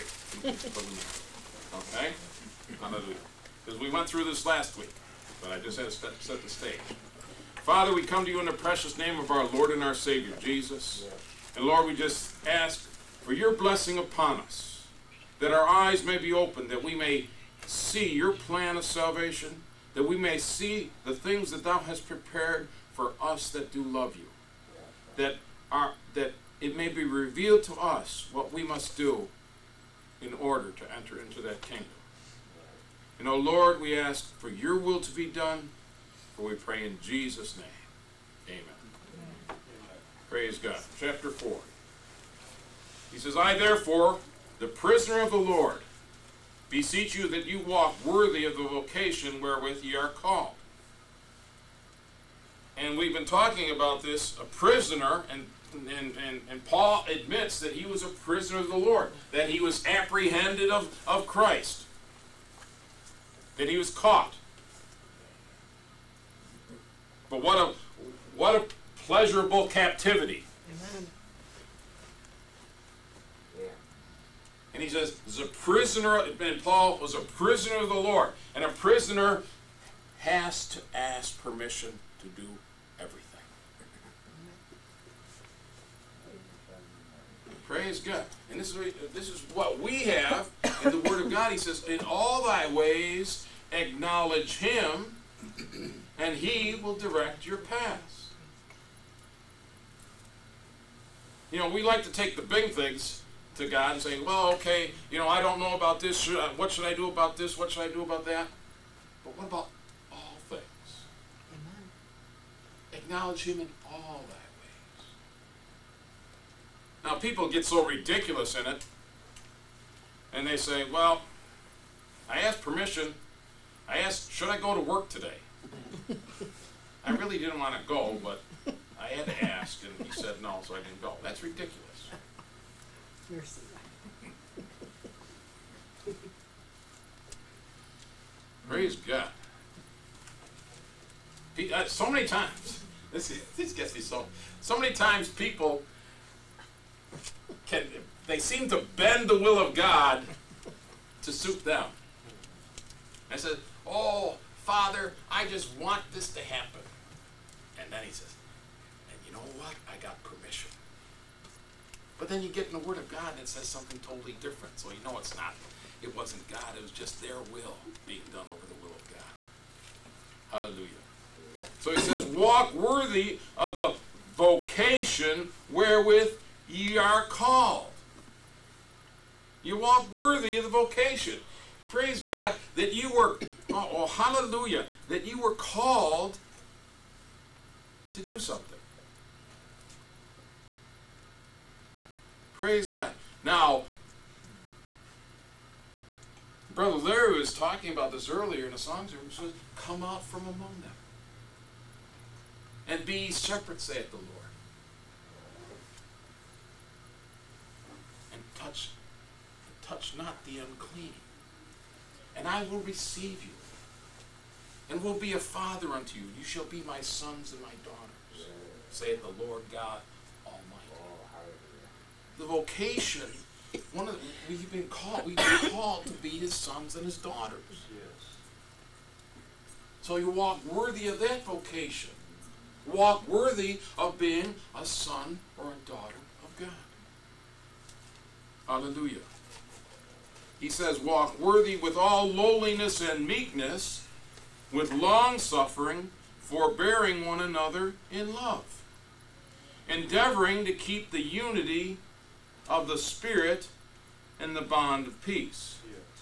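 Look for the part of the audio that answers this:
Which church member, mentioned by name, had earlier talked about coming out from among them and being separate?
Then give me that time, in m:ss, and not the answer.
3:16.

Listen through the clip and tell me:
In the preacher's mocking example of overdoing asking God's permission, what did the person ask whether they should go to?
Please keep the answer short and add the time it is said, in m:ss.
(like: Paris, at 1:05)
work, at 2:04.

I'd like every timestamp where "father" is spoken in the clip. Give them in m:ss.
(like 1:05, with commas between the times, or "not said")
0:07, 2:34, 3:35.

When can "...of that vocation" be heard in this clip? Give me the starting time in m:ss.
3:51.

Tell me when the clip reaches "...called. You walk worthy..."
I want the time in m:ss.
2:57.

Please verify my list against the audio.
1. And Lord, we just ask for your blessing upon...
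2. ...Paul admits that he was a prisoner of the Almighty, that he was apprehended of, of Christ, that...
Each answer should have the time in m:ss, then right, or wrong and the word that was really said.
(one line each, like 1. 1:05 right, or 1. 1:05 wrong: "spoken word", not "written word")
1. 0:11 right
2. 0:56 wrong: "Lord", not "Almighty".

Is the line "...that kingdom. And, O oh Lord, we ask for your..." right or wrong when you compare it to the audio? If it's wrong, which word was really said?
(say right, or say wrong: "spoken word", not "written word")
right.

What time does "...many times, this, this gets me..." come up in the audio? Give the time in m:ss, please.
2:22.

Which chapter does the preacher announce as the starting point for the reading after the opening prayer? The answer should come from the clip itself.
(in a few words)
Chapter 4.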